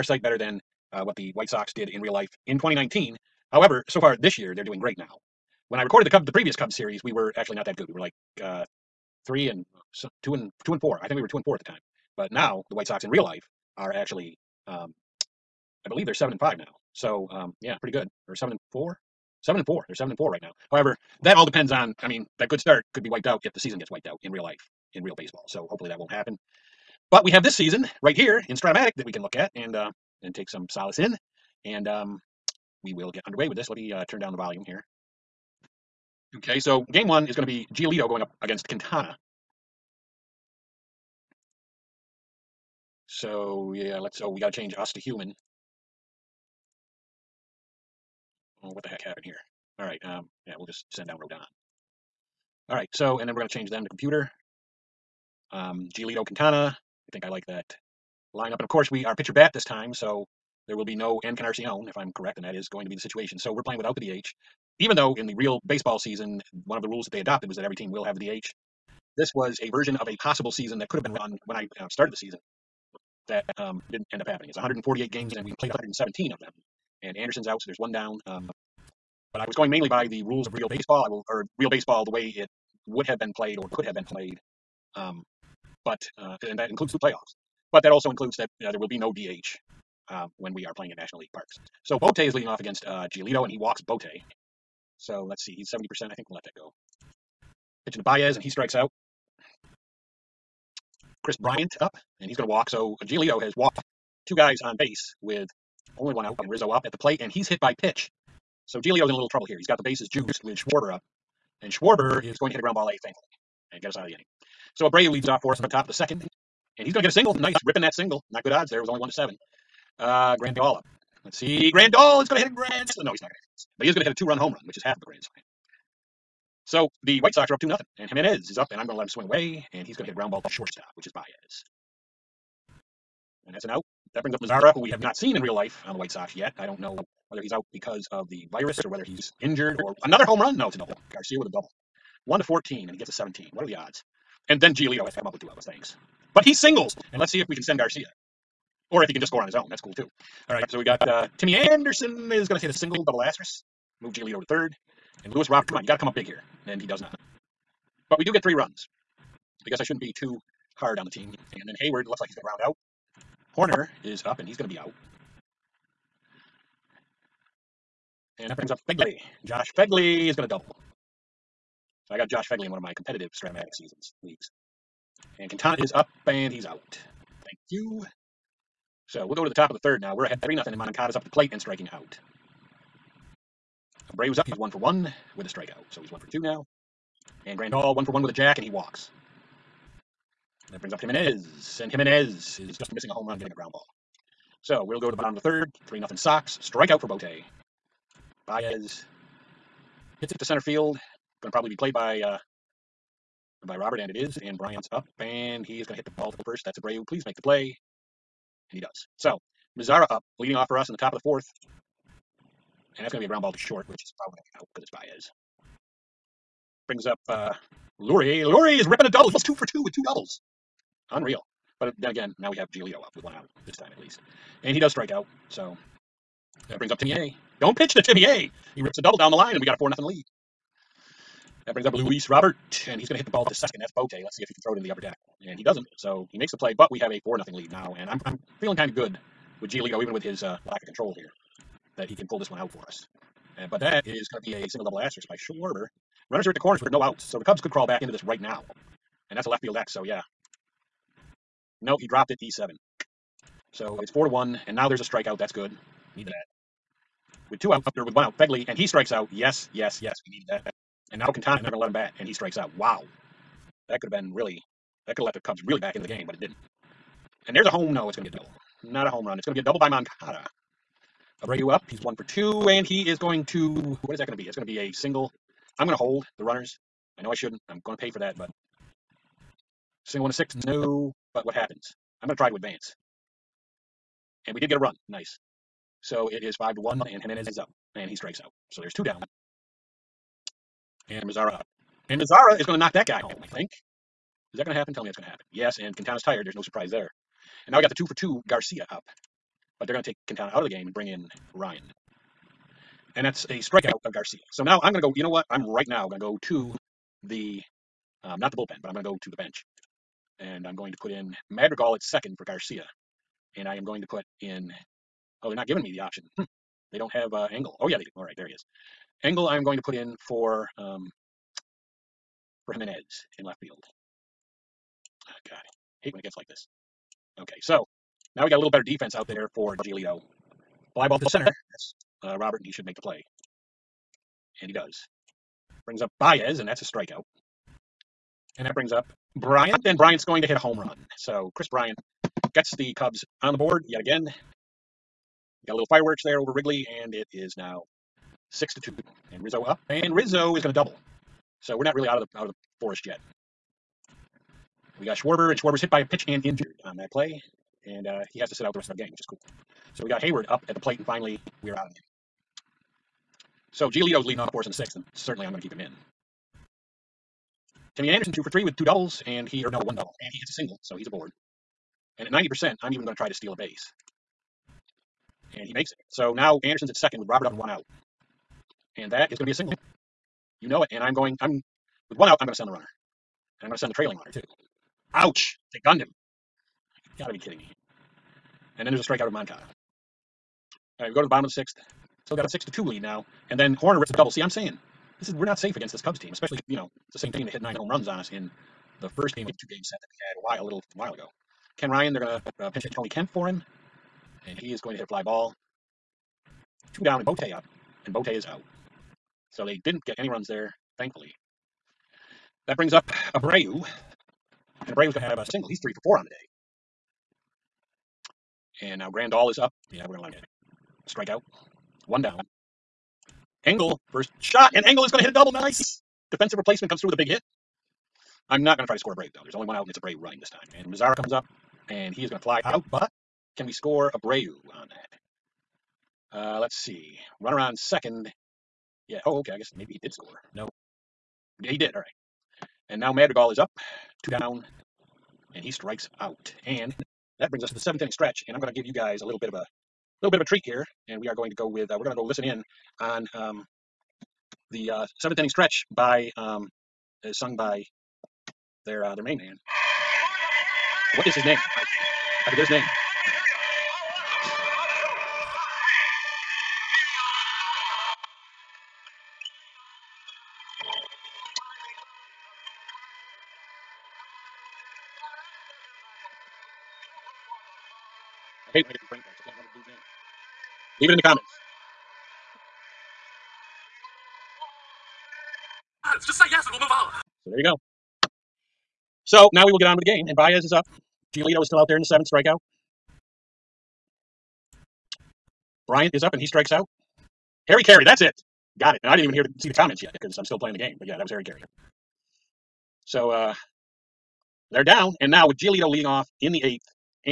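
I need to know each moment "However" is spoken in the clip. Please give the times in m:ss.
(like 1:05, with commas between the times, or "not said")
0:03, 0:20.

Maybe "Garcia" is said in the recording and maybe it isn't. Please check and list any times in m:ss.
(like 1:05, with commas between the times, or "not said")
2:21, 2:27, 4:58, 5:04, 5:12.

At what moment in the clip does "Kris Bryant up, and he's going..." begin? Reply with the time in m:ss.
1:41.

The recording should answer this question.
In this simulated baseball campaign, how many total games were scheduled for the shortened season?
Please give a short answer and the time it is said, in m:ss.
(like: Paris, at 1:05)
148, at 1:14.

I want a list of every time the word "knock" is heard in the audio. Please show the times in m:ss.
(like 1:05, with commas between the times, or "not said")
4:52.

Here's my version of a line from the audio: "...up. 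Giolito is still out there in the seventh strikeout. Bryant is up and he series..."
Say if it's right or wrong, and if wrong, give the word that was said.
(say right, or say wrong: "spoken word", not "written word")
wrong: "strikes", not "series".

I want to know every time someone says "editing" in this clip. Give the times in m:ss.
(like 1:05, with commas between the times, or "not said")
not said.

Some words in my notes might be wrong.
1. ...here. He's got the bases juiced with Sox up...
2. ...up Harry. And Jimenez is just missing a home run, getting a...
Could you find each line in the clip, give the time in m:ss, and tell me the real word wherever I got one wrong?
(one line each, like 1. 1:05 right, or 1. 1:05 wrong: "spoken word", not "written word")
1. 1:49 wrong: "Schwarber", not "Sox"
2. 3:10 wrong: "Jimenez", not "Harry".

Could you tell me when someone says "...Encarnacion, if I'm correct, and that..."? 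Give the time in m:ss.
1:01.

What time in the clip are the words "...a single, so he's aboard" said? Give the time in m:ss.
6:10.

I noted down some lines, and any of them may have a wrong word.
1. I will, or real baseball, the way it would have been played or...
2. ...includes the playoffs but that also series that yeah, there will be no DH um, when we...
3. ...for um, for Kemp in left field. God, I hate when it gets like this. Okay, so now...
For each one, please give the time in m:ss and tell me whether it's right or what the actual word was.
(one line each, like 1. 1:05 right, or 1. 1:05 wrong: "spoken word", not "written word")
1. 1:21 right
2. 1:26 wrong: "includes", not "series"
3. 5:20 wrong: "Jimenez", not "Kemp".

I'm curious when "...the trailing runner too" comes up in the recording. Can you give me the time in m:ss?
6:23.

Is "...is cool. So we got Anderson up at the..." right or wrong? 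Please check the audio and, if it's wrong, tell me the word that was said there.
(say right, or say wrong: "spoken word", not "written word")
wrong: "Heyward", not "Anderson".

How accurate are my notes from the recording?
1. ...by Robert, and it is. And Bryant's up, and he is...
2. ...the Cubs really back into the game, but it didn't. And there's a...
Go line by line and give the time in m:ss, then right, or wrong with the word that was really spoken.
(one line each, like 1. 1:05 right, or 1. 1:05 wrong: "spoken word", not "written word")
1. 3:23 right
2. 4:25 right.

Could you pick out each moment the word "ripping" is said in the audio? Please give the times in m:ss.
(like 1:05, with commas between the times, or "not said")
1:57, 3:38.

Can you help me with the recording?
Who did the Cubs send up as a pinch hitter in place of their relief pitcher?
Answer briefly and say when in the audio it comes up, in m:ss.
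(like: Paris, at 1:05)
Tony Kemp, at 6:42.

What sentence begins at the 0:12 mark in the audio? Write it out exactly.
But now the White Sox in real life are actually, um, I believe they're seven and five now.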